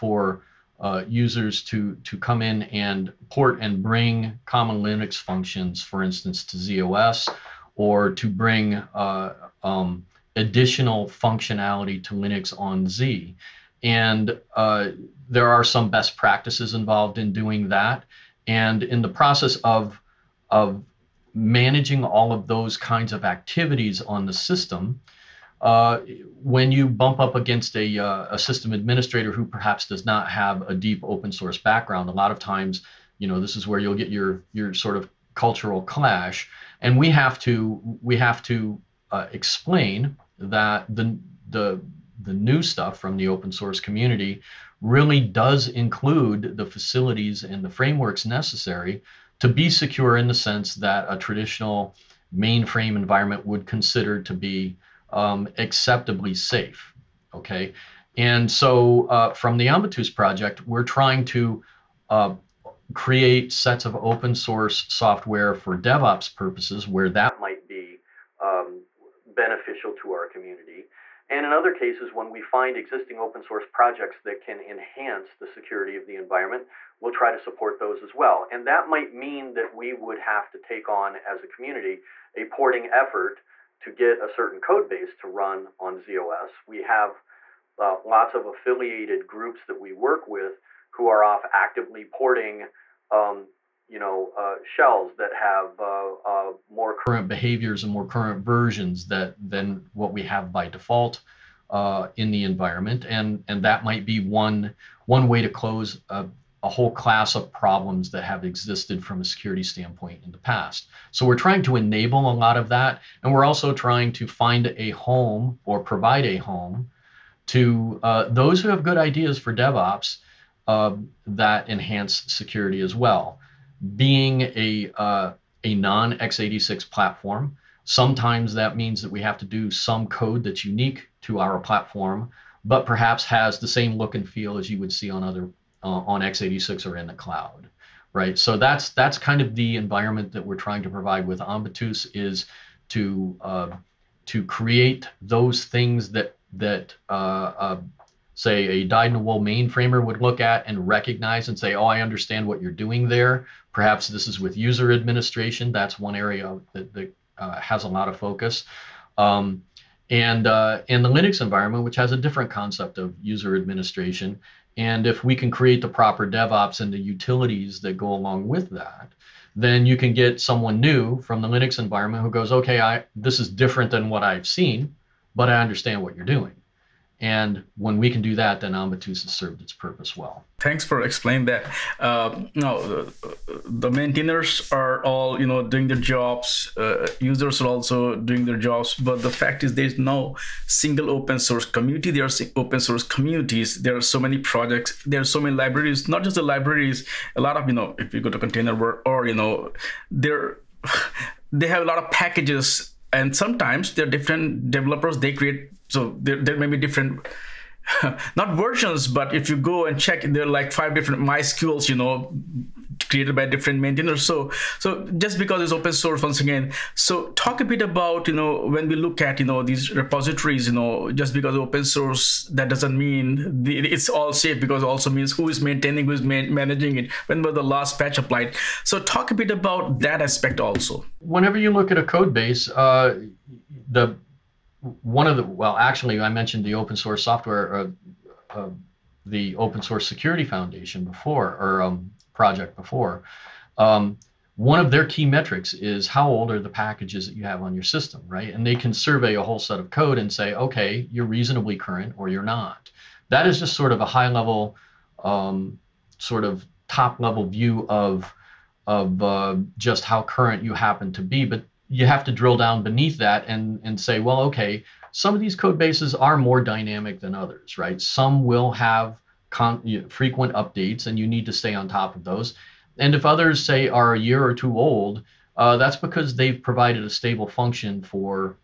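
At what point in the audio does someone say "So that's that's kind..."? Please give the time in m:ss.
2:18.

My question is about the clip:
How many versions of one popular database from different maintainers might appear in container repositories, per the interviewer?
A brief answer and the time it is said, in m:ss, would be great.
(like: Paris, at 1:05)
5, at 3:30.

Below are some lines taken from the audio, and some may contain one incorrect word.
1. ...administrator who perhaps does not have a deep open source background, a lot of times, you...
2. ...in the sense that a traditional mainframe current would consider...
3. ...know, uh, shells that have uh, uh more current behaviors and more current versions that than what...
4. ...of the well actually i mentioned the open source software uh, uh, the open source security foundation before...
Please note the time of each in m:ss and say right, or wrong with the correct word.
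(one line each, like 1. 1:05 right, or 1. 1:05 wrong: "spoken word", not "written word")
1. 0:28 right
2. 0:50 wrong: "environment", not "current"
3. 1:33 right
4. 3:55 right.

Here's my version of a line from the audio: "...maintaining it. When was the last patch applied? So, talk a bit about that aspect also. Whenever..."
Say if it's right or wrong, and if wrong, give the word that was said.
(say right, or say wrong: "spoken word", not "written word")
wrong: "managing", not "maintaining".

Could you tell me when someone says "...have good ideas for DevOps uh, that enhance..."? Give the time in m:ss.
1:58.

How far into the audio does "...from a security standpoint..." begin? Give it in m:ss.
1:49.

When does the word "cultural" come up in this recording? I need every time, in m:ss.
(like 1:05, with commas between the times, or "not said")
0:35.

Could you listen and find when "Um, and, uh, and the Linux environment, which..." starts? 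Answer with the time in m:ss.
2:39.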